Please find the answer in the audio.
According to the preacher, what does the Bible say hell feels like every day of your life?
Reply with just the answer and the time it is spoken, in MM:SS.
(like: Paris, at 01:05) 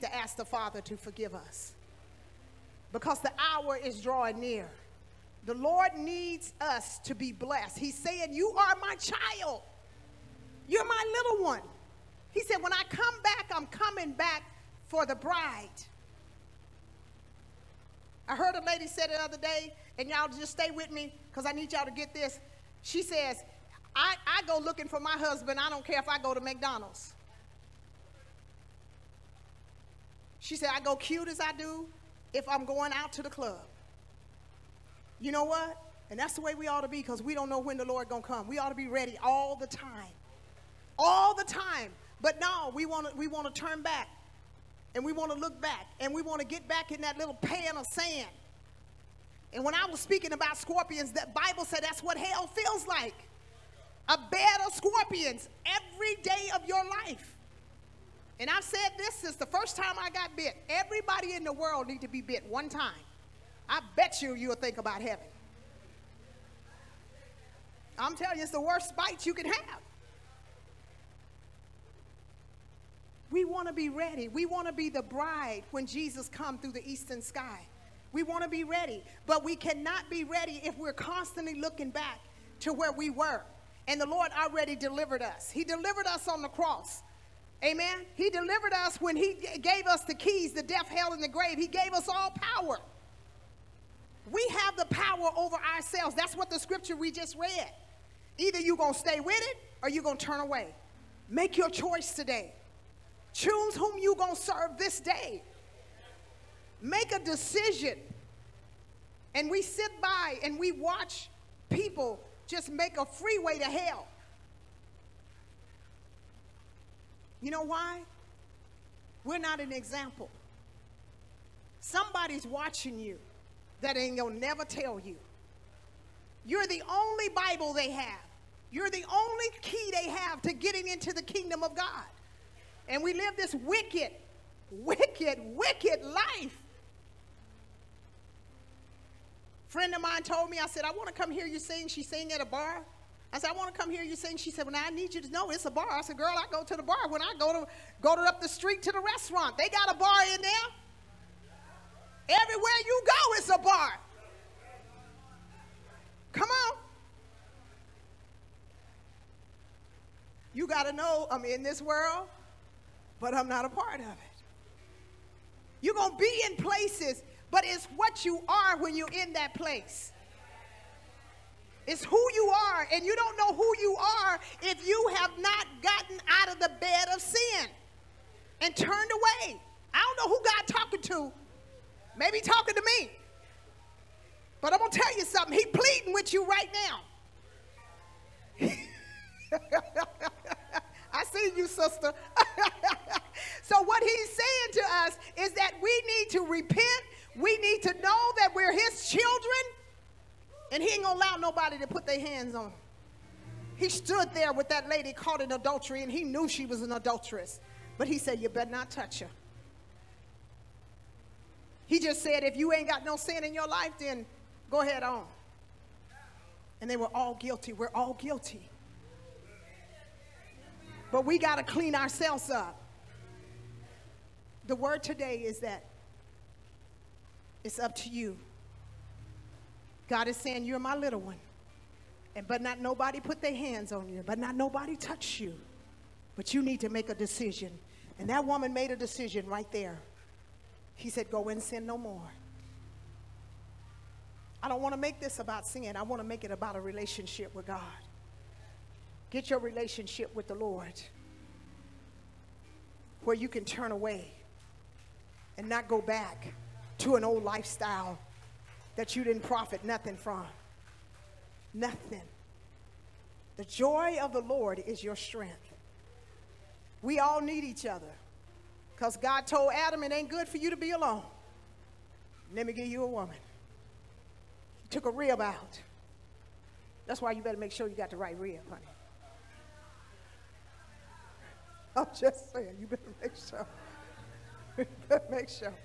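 A bed of scorpions, at 00:54.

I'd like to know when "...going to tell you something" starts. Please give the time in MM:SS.
03:04.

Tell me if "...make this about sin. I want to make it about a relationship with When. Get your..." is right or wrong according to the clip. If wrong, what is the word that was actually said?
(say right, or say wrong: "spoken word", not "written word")
wrong: "God", not "When".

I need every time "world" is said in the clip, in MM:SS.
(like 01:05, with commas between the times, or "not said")
01:01, 02:41.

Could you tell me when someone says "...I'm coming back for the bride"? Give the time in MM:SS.
00:13.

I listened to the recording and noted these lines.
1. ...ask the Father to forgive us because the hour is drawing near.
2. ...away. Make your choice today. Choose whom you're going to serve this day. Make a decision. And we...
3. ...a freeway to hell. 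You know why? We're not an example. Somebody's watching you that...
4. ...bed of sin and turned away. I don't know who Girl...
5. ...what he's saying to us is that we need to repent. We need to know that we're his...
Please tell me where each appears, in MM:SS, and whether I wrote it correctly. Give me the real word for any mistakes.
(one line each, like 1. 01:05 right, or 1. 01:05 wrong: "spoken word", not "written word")
1. 00:00 right
2. 01:40 right
3. 01:52 right
4. 02:56 wrong: "God", not "Girl"
5. 03:13 right.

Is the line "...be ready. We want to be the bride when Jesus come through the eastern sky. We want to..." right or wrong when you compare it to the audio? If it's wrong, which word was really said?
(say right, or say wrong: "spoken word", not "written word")
right.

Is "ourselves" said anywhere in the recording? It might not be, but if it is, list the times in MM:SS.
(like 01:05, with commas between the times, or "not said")
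01:35, 03:41.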